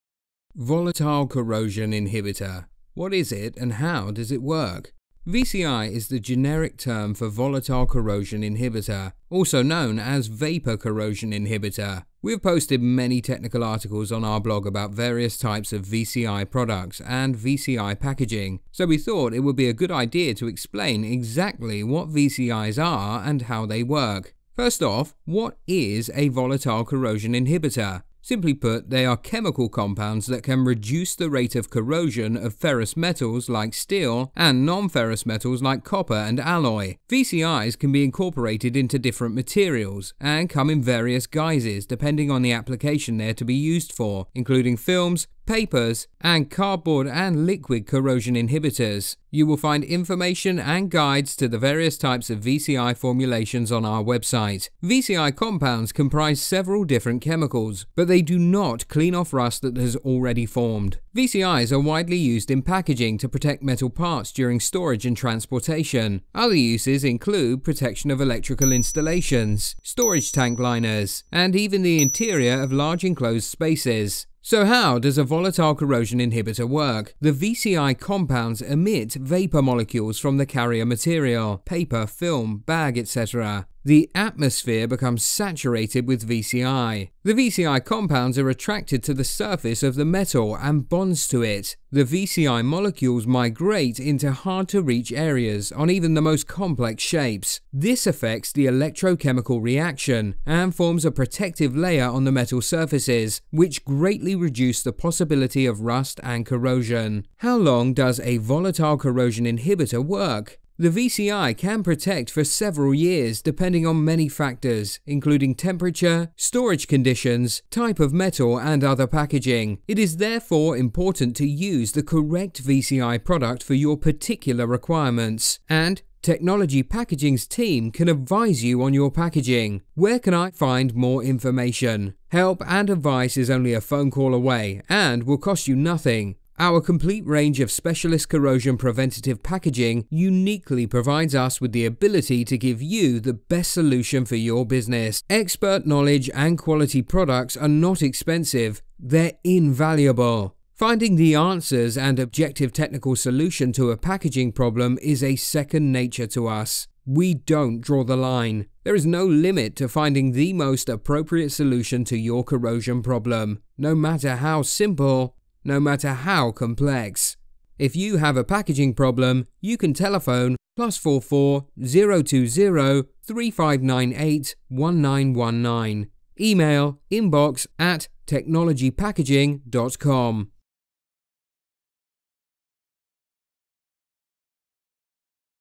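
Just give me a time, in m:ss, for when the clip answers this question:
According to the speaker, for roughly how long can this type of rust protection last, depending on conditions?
1:52.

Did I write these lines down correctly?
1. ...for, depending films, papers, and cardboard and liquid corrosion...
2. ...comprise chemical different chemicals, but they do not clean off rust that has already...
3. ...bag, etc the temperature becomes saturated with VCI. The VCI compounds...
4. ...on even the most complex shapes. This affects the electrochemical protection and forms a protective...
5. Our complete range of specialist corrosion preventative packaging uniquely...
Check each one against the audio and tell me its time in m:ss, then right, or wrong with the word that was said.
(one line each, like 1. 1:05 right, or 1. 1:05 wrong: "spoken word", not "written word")
1. 0:43 wrong: "including", not "depending"
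2. 0:55 wrong: "several", not "chemical"
3. 1:22 wrong: "atmosphere", not "temperature"
4. 1:35 wrong: "reaction", not "protection"
5. 2:16 right.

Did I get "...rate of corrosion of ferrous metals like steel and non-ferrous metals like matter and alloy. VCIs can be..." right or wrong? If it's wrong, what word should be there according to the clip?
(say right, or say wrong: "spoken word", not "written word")
wrong: "copper", not "matter".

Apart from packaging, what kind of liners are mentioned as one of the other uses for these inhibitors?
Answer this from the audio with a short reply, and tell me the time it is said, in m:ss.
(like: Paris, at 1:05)
storage tank liners, at 1:09.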